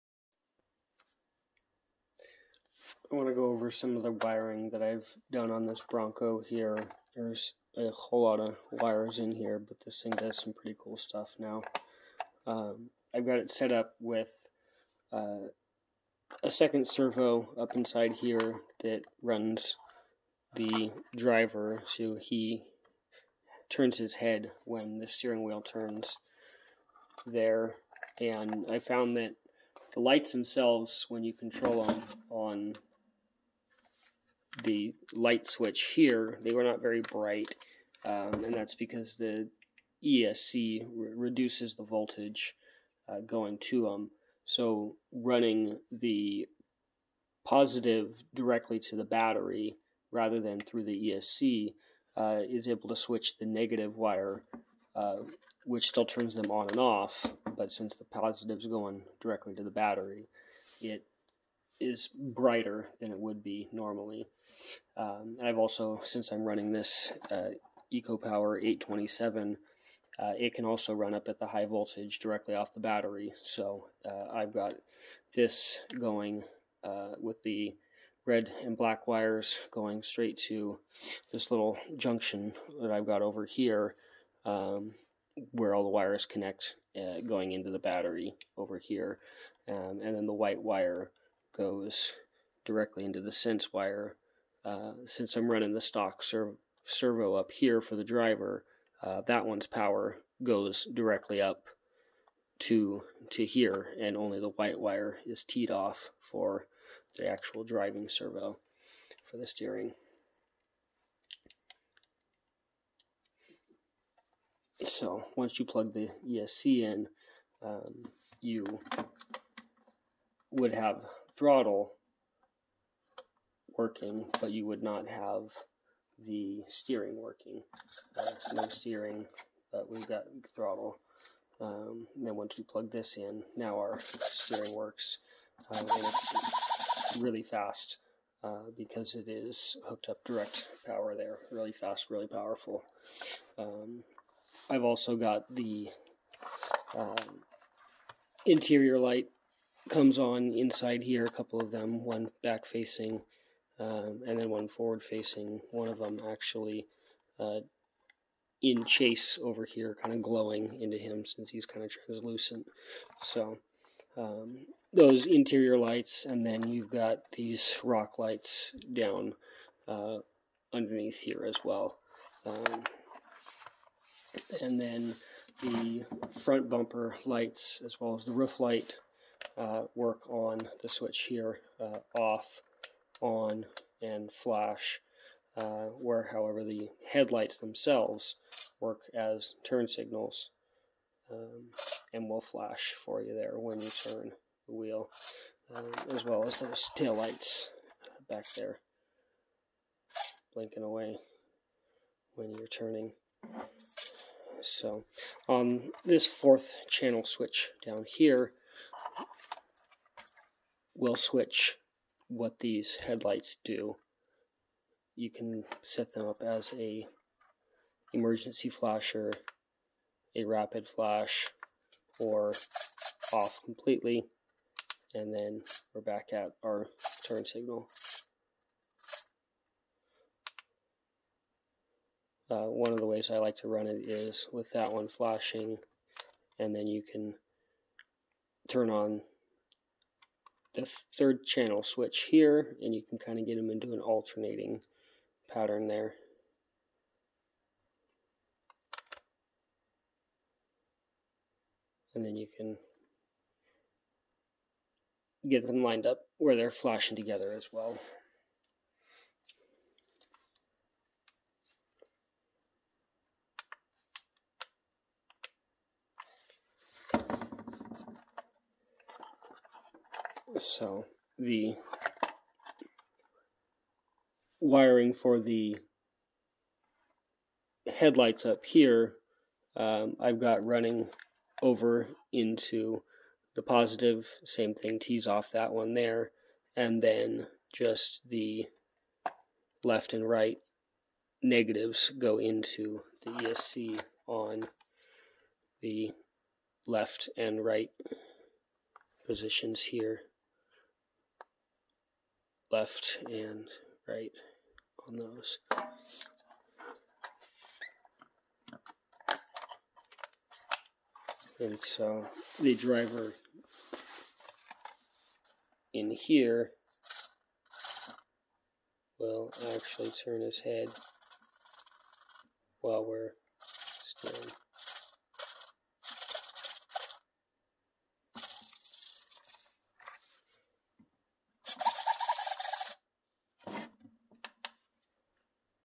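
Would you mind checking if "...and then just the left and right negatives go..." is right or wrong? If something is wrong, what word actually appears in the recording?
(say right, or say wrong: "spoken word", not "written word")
right.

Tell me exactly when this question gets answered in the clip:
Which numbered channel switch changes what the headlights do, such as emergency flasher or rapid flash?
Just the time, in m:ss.
3:26.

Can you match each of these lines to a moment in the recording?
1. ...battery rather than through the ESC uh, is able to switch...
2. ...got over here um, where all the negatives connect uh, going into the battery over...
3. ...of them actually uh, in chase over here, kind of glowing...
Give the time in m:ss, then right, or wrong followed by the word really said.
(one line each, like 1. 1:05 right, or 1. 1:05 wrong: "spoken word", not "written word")
1. 0:49 right
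2. 1:23 wrong: "wires", not "negatives"
3. 2:35 right.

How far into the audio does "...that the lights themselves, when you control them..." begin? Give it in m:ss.
0:29.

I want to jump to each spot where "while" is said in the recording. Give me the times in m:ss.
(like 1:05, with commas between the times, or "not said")
5:22.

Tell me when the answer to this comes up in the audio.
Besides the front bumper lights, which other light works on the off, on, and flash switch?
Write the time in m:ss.
2:58.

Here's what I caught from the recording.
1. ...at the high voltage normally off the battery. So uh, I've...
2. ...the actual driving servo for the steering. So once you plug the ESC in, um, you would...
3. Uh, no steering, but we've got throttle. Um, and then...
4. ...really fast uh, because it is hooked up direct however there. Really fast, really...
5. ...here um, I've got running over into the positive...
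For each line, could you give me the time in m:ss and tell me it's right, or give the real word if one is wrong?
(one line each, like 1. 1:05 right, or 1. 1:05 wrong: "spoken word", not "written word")
1. 1:11 wrong: "directly", not "normally"
2. 1:47 right
3. 2:08 right
4. 2:17 wrong: "power", not "however"
5. 4:38 right.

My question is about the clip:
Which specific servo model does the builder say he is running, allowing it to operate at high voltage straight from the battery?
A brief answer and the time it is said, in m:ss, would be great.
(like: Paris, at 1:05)
EcoPower 827, at 1:07.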